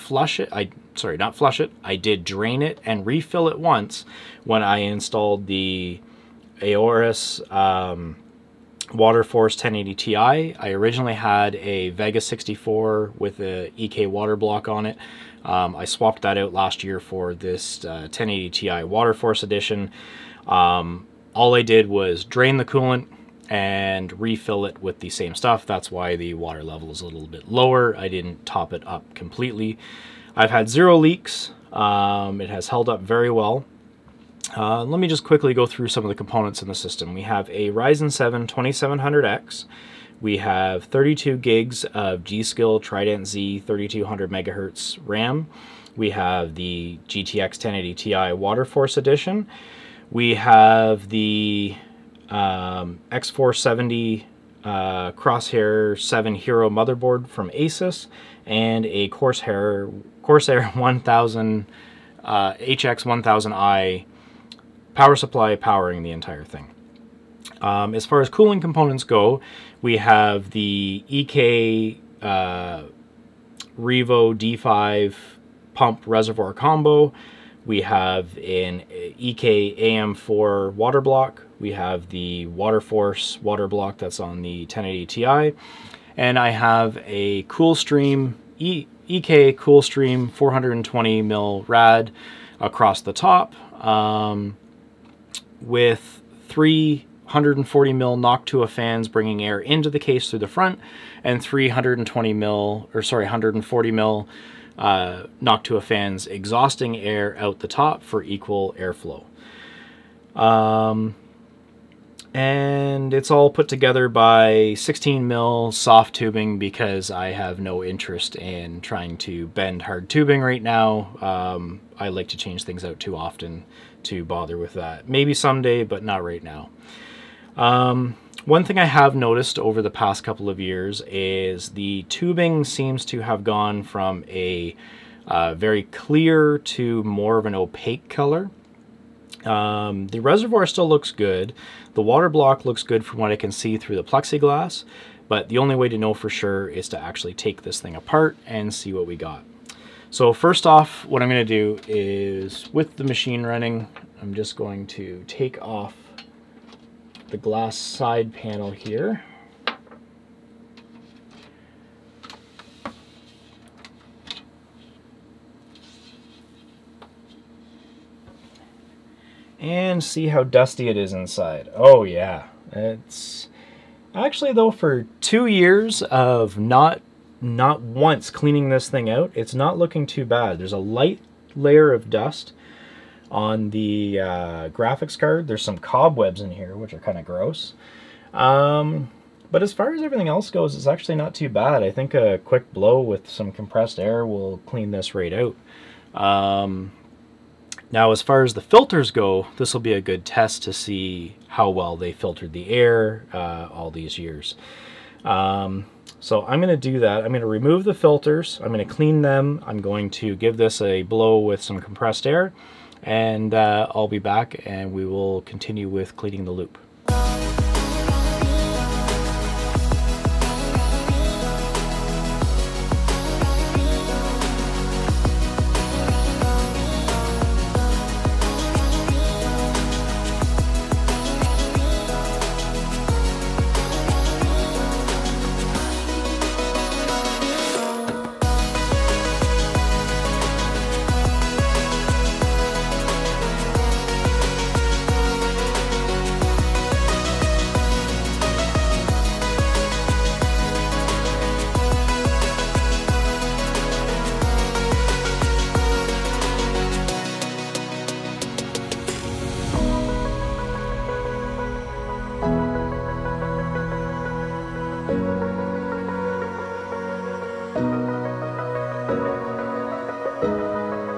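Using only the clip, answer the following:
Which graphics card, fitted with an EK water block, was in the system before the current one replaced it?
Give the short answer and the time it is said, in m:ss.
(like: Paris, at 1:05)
Vega 64, at 0:11.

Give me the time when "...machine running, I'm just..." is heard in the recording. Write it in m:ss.
2:33.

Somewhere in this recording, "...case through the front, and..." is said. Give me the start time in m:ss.
1:39.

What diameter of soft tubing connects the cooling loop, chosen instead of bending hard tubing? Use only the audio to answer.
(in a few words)
16 mm.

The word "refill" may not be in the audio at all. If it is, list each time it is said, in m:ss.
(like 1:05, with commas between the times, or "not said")
0:03, 0:24.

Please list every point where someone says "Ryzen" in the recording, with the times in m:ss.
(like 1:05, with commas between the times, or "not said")
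0:37.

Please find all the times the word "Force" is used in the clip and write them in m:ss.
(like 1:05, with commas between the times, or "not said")
0:09, 0:19, 0:48, 1:22.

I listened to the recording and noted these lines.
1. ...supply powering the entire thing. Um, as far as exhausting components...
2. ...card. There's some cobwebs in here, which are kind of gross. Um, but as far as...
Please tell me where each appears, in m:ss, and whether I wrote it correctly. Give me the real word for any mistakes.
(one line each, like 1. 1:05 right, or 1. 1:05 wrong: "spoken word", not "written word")
1. 1:05 wrong: "cooling", not "exhausting"
2. 3:05 right.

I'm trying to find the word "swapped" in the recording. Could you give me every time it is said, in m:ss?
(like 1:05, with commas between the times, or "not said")
0:15.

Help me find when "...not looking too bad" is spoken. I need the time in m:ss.
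2:59.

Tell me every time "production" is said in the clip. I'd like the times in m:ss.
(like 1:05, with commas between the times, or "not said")
not said.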